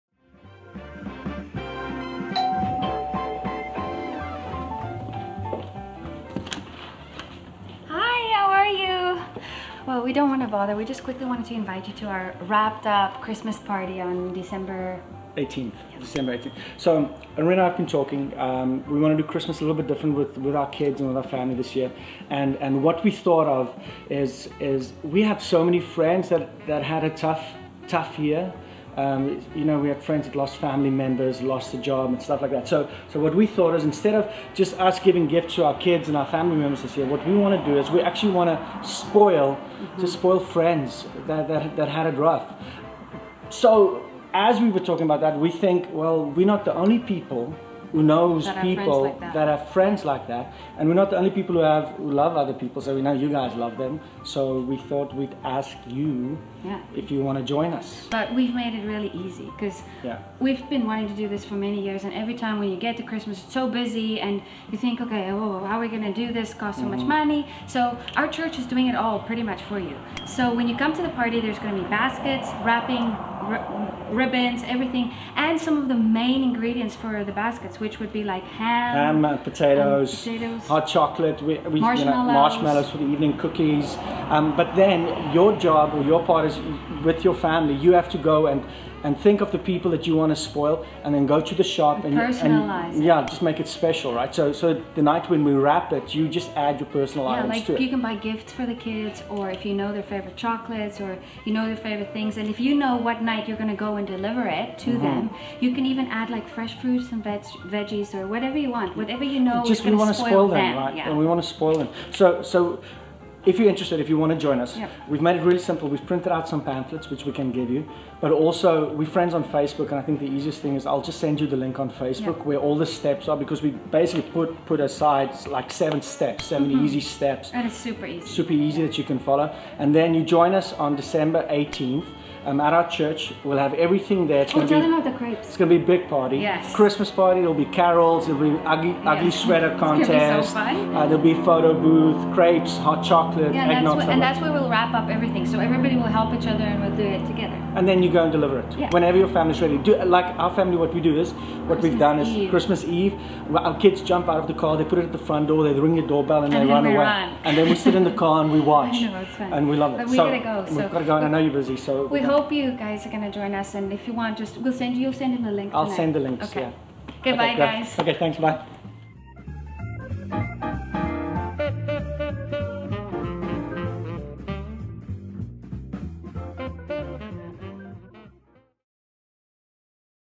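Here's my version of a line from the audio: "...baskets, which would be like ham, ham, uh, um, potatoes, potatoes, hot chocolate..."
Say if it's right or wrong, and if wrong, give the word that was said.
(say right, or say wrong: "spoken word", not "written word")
right.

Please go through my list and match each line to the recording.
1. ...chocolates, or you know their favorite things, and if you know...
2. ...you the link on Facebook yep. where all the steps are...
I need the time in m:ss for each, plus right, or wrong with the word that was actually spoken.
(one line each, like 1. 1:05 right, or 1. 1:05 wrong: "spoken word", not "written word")
1. 1:40 right
2. 2:01 right.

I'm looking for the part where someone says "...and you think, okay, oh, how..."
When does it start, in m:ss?
1:04.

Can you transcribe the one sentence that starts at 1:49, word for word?
Just we want to spoil, them, them, right?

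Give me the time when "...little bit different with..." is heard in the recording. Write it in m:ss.
0:19.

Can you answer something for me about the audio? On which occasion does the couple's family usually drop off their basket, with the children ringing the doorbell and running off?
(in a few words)
Christmas Eve.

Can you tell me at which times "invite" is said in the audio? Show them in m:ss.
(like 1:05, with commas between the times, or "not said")
0:11.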